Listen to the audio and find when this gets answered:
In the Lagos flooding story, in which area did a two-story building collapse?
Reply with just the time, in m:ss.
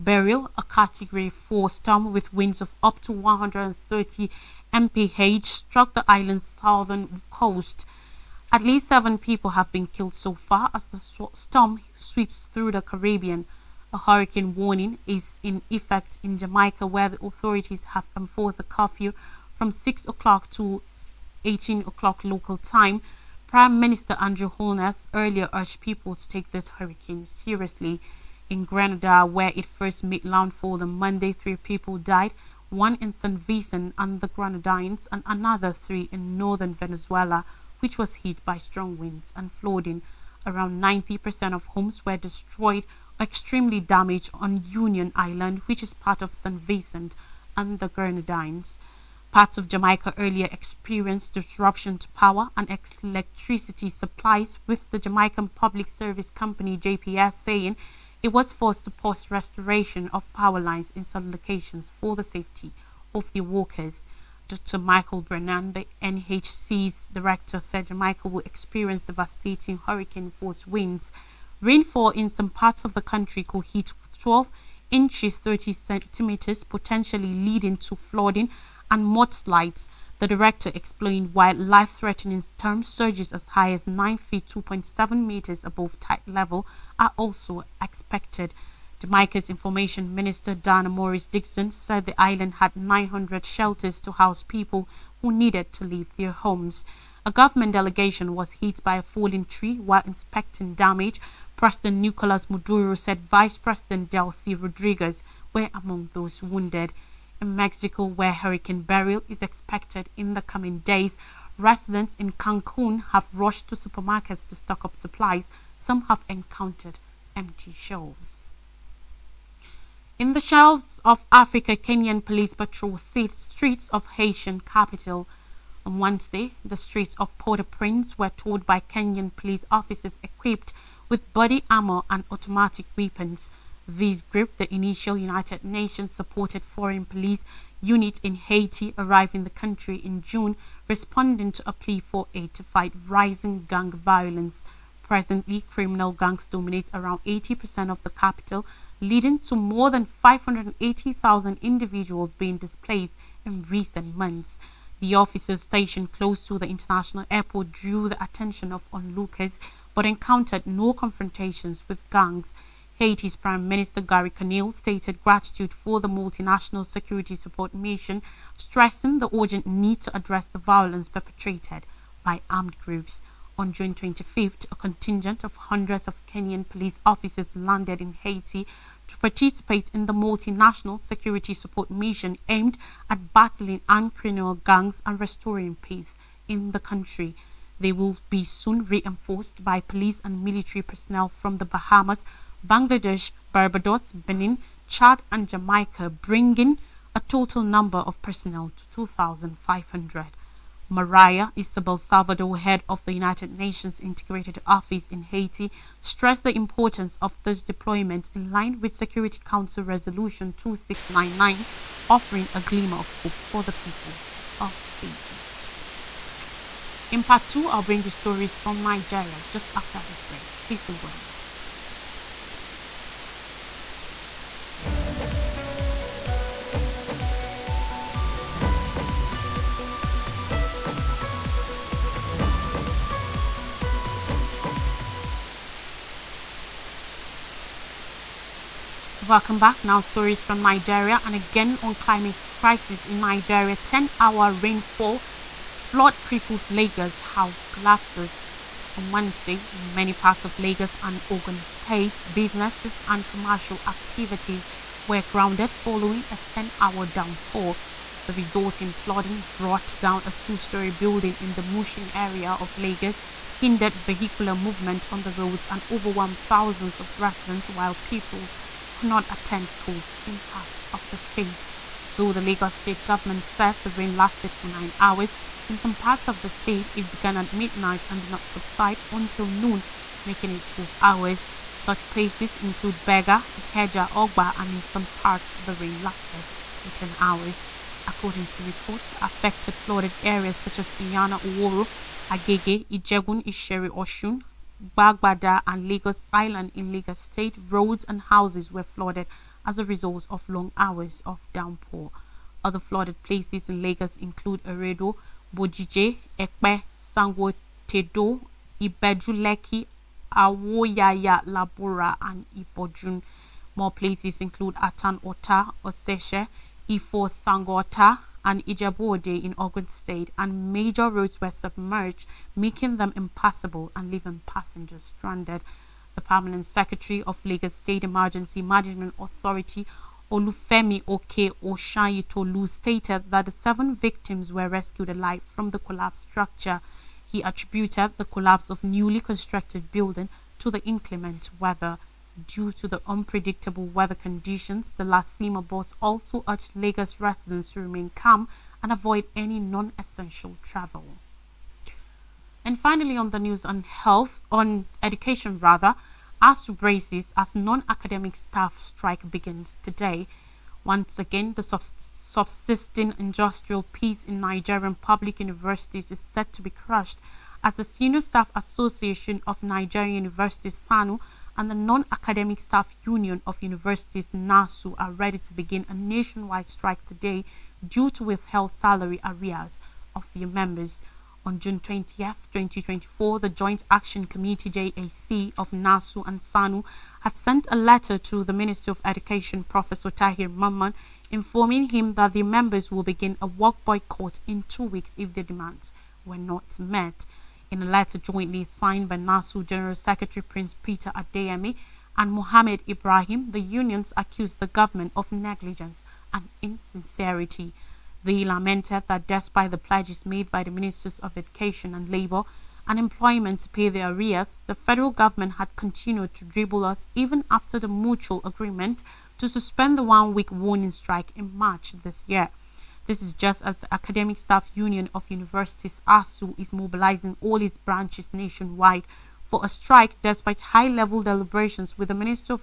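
4:21.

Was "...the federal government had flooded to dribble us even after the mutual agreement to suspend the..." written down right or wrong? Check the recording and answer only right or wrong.
wrong.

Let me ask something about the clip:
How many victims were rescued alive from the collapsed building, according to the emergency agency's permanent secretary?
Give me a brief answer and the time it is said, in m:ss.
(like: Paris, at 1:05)
7, at 5:33.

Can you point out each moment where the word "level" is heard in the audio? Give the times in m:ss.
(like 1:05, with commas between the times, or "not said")
1:26, 7:10.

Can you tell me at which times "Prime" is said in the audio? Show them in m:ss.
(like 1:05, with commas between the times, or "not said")
0:23, 2:43.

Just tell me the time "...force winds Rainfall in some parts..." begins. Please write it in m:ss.
1:10.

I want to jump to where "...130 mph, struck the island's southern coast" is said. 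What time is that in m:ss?
0:03.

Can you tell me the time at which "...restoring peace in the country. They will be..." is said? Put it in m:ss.
3:05.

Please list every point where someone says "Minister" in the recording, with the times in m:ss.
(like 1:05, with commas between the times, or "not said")
0:23, 1:30, 2:43, 6:28, 6:50.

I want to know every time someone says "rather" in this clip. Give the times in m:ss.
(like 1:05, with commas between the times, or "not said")
5:55.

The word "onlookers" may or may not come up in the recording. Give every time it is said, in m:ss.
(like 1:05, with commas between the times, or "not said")
2:38.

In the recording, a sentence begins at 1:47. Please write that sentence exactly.
In Mexico, where Hurricane Beryl is expected in the coming days, residents in Cancun have rushed to supermarkets to stock up supplies.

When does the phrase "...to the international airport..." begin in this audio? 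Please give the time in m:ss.
2:36.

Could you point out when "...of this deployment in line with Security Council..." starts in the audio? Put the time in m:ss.
3:27.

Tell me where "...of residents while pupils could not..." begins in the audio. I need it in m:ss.
4:26.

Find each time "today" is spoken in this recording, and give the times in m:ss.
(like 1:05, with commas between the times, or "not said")
5:59, 6:17.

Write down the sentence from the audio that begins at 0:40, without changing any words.
Around 90% of homes were destroyed, extremely damaged on Union Island, which is part of St.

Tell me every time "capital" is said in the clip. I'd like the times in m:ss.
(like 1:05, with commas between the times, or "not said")
2:04, 2:28.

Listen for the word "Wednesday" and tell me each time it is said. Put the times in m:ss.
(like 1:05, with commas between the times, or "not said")
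2:05, 4:09.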